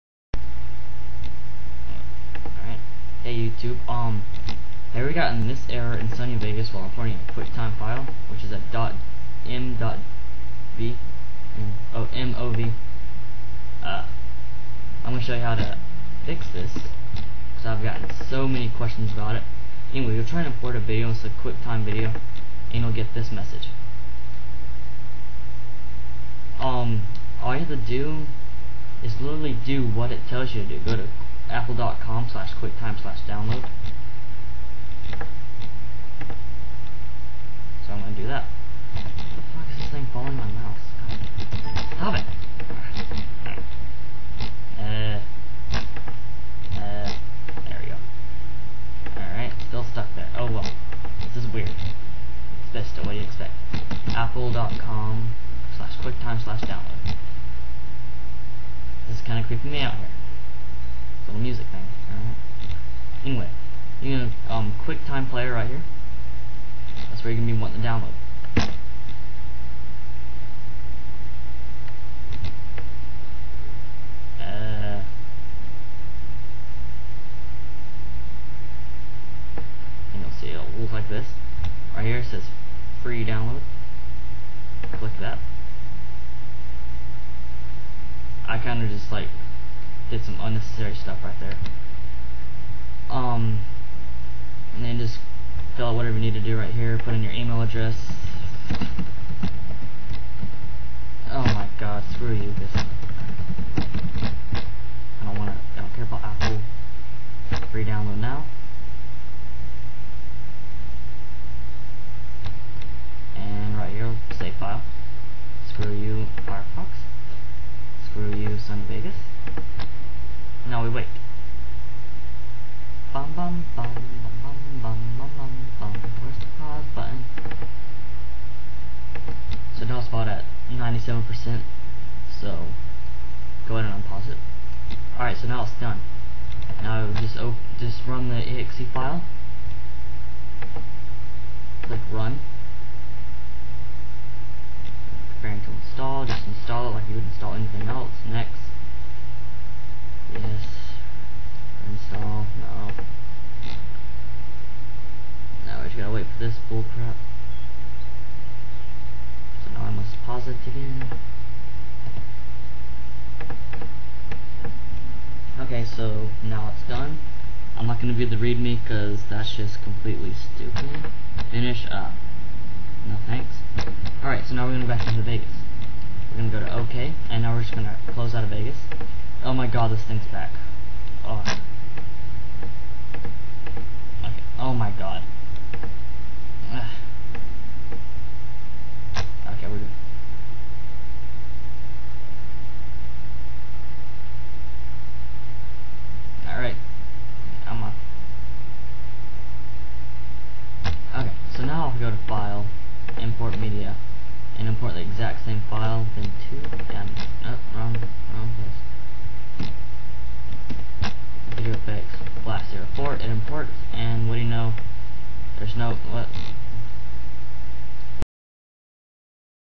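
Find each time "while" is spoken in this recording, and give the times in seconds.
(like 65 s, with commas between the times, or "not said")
6 s.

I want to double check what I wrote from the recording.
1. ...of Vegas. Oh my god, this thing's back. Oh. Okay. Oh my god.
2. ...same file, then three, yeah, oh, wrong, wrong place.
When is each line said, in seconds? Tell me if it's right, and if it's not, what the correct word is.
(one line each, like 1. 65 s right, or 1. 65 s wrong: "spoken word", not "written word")
1. 178 s right
2. 205 s wrong: "two", not "three".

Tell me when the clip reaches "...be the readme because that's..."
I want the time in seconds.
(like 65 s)
168 s.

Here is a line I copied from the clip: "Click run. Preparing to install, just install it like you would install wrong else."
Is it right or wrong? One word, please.
wrong.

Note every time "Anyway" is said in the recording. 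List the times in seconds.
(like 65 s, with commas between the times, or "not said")
19 s, 63 s.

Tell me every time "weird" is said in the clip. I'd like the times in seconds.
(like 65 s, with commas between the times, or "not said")
51 s.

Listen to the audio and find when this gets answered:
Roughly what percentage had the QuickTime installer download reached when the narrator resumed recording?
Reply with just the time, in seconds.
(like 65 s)
130 s.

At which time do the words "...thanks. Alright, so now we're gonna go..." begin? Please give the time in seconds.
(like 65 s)
173 s.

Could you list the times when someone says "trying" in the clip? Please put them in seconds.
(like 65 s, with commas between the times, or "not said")
20 s.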